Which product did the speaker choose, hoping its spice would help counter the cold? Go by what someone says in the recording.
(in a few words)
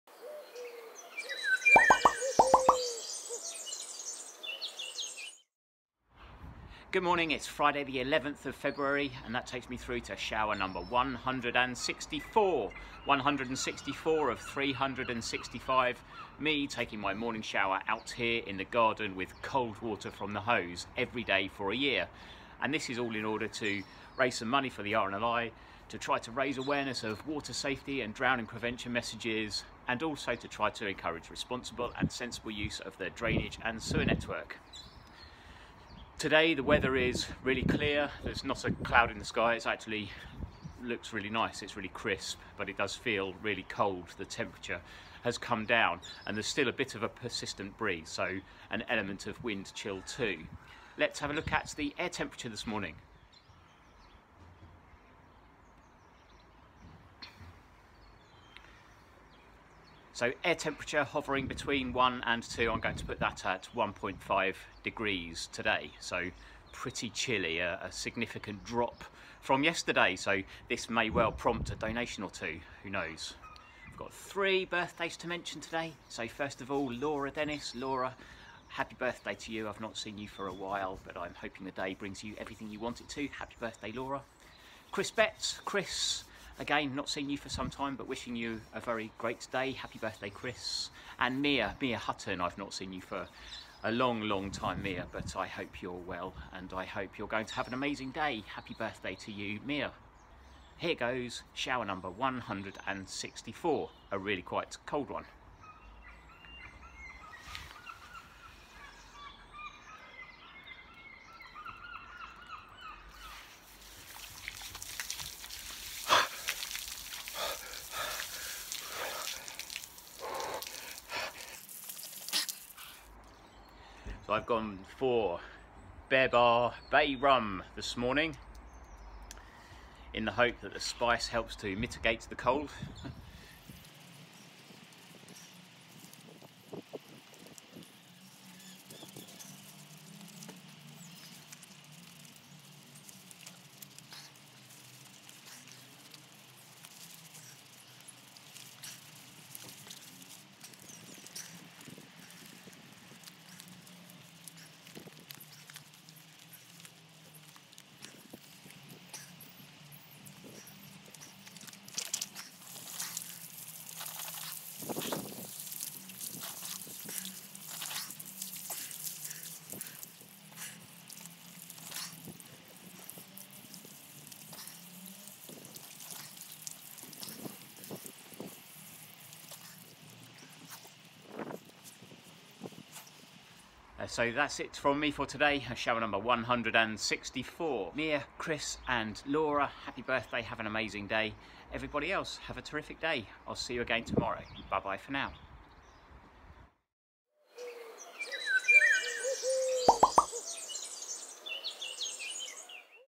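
Bear Bar Bay Rum.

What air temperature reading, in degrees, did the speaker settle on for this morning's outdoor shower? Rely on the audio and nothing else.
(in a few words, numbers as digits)
1.5.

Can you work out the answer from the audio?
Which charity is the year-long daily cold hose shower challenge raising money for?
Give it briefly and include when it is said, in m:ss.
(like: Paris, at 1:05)
RNLI, at 0:24.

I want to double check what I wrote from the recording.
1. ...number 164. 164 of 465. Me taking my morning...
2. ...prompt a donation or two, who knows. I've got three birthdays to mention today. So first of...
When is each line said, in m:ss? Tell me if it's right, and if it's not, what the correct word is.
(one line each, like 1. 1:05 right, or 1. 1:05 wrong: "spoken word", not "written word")
1. 0:10 wrong: "365", not "465"
2. 1:11 right.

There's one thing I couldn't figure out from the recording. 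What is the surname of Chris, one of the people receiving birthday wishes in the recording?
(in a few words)
Betts.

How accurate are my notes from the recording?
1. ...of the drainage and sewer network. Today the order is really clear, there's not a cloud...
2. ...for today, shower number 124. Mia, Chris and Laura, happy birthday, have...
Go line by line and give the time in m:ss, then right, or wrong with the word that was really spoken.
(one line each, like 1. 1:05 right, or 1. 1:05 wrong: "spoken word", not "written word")
1. 0:32 wrong: "weather", not "order"
2. 3:05 wrong: "164", not "124".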